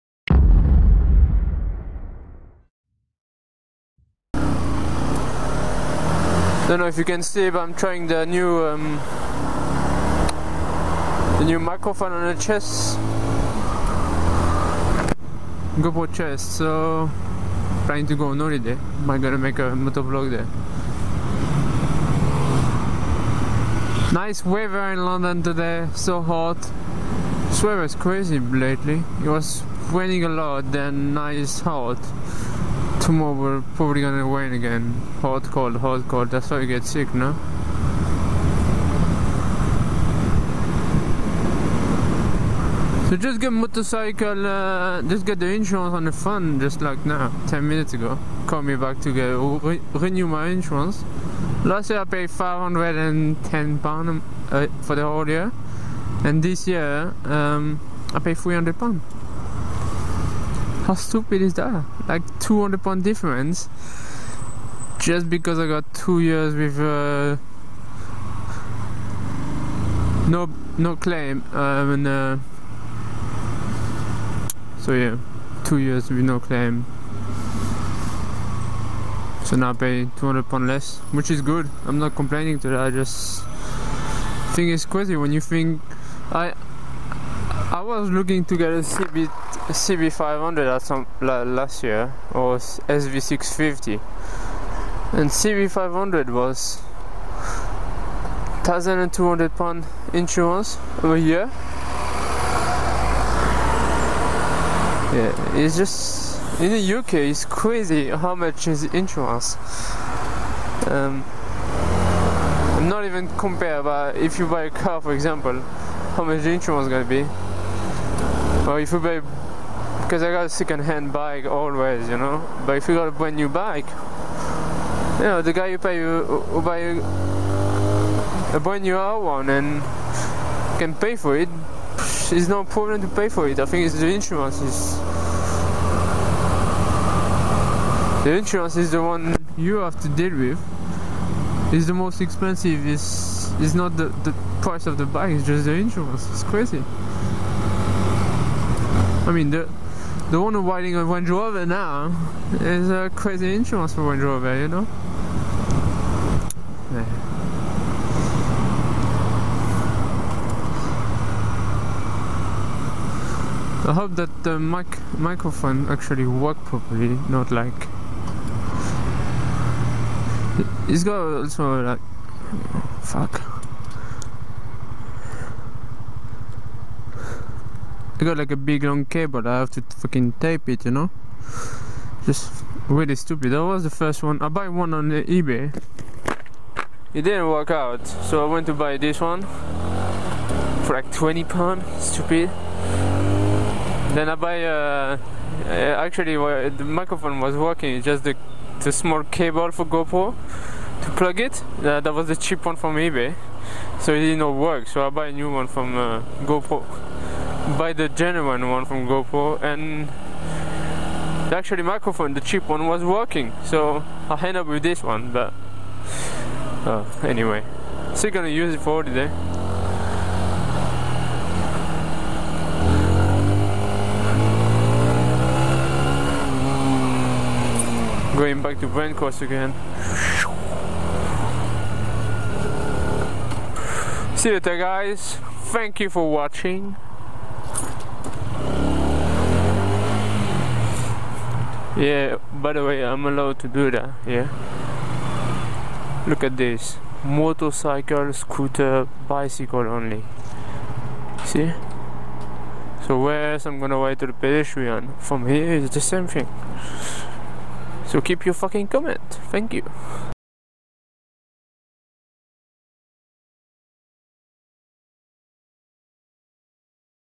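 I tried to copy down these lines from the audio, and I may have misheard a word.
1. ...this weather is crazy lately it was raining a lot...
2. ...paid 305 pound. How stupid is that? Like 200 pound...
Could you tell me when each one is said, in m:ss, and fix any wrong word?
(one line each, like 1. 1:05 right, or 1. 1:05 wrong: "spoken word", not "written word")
1. 0:27 right
2. 0:58 wrong: "300", not "305".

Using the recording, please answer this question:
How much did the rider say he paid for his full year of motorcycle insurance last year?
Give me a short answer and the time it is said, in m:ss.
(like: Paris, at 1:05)
£510, at 0:52.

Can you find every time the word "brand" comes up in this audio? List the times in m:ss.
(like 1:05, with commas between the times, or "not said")
2:03, 2:08.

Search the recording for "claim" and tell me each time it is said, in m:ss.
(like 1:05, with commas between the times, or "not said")
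1:10, 1:16.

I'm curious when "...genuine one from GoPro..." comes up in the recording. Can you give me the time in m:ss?
3:28.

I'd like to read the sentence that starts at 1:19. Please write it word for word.
So now I pay 200 pound less, which is good.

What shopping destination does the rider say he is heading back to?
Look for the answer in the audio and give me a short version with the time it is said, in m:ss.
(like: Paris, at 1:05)
Brent Cross, at 3:48.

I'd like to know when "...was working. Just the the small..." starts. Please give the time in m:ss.
3:17.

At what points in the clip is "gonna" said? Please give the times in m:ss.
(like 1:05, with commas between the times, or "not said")
0:19, 0:33, 1:56, 3:38, 4:13.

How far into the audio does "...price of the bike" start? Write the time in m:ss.
2:24.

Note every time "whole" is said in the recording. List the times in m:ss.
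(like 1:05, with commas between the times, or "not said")
0:55.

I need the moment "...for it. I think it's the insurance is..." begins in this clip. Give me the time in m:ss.
2:13.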